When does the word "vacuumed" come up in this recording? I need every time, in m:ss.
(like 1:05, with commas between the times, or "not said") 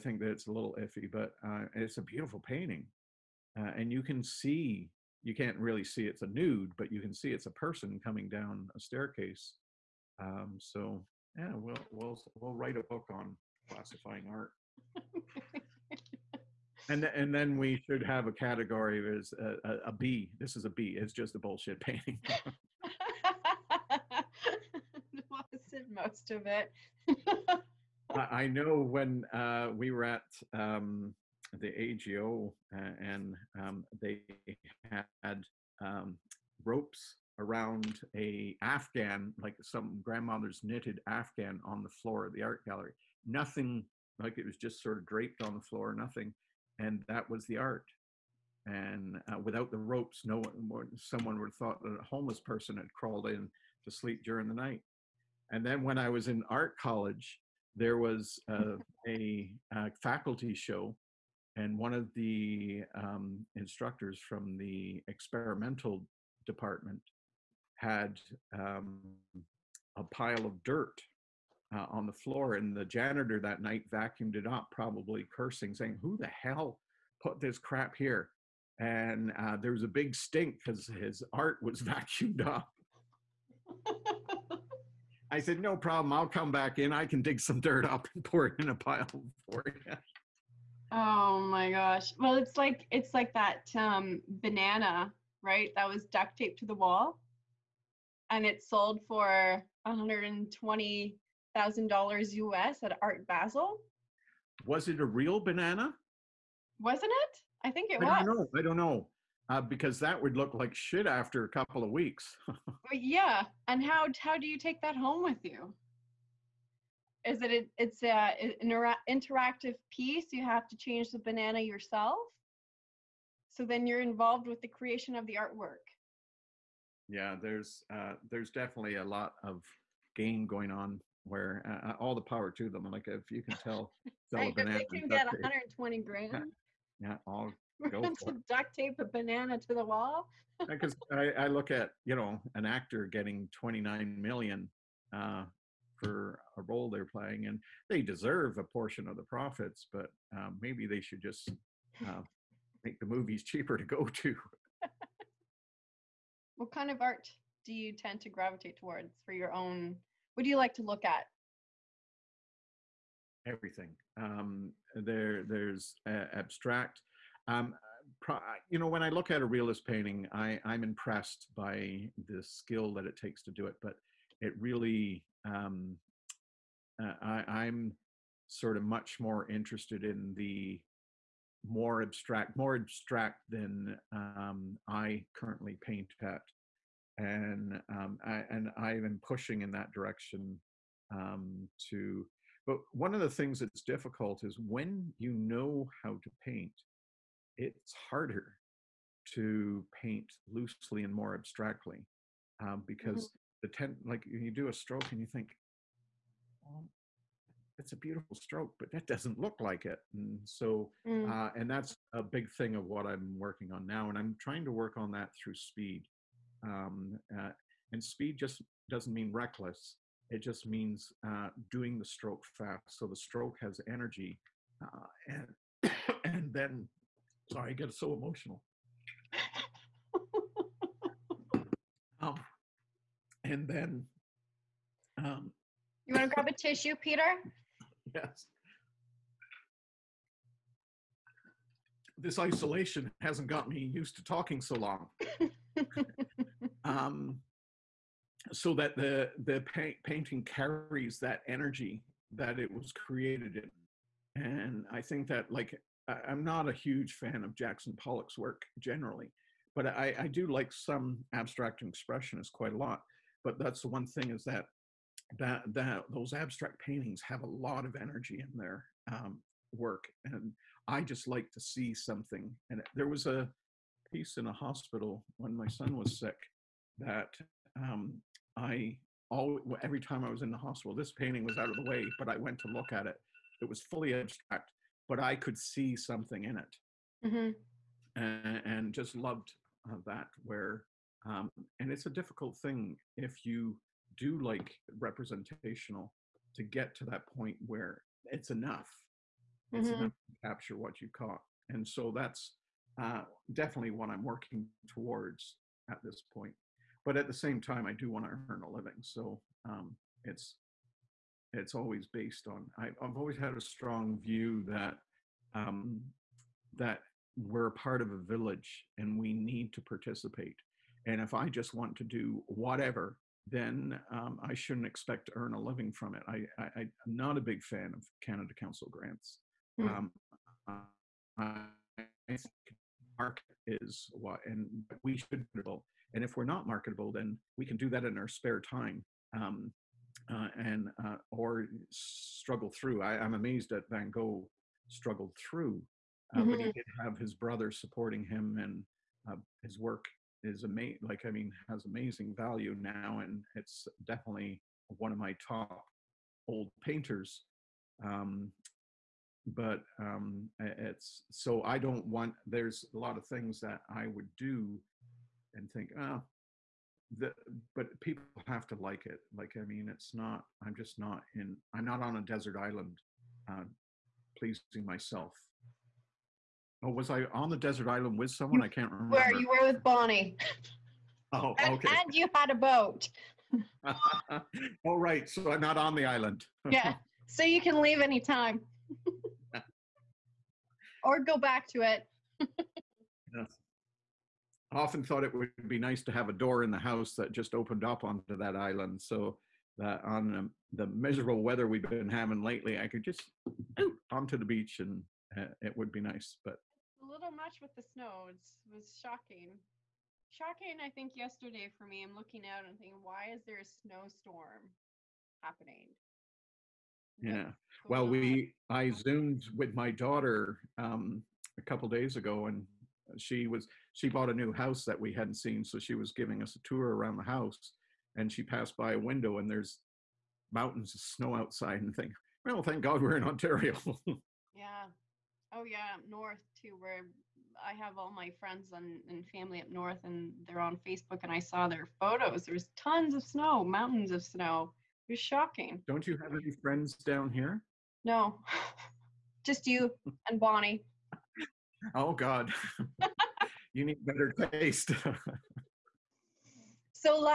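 1:13, 1:21.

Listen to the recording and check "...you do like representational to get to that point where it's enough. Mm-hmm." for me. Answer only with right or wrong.
right.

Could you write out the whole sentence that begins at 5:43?
I, am amazed that Van Gogh struggled through, mm-hmm.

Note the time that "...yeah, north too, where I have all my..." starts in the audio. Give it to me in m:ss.
7:15.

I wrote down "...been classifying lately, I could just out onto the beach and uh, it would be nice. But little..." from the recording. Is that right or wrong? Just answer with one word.
wrong.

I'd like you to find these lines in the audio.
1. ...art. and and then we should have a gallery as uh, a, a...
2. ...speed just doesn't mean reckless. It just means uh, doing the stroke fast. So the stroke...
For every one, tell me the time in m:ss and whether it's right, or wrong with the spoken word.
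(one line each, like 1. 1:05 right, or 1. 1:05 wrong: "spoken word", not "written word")
1. 0:14 wrong: "category", not "gallery"
2. 3:38 right.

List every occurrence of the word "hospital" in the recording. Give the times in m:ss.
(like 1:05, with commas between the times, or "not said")
4:34, 4:40.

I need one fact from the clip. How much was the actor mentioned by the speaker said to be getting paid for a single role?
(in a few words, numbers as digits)
29 million.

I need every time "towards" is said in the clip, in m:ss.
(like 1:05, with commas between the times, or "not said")
2:38, 5:04.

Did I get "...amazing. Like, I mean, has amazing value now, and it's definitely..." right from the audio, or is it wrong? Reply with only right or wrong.
right.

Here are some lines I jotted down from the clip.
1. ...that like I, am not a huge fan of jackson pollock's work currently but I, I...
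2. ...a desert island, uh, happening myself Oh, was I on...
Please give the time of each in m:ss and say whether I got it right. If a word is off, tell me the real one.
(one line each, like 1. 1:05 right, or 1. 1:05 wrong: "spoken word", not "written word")
1. 4:15 wrong: "generally", not "currently"
2. 6:12 wrong: "pleasing", not "happening".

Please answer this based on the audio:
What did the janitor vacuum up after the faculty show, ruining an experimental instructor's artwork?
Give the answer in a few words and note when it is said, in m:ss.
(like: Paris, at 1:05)
A pile of dirt, at 1:09.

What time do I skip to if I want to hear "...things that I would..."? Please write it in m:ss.
6:03.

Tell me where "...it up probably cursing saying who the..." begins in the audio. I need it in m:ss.
1:14.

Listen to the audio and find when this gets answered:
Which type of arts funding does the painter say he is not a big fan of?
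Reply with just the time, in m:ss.
5:28.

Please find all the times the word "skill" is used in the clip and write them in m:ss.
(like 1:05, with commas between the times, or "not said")
2:52.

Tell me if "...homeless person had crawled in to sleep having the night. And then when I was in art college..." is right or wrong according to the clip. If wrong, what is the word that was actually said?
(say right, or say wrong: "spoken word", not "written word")
wrong: "during", not "having".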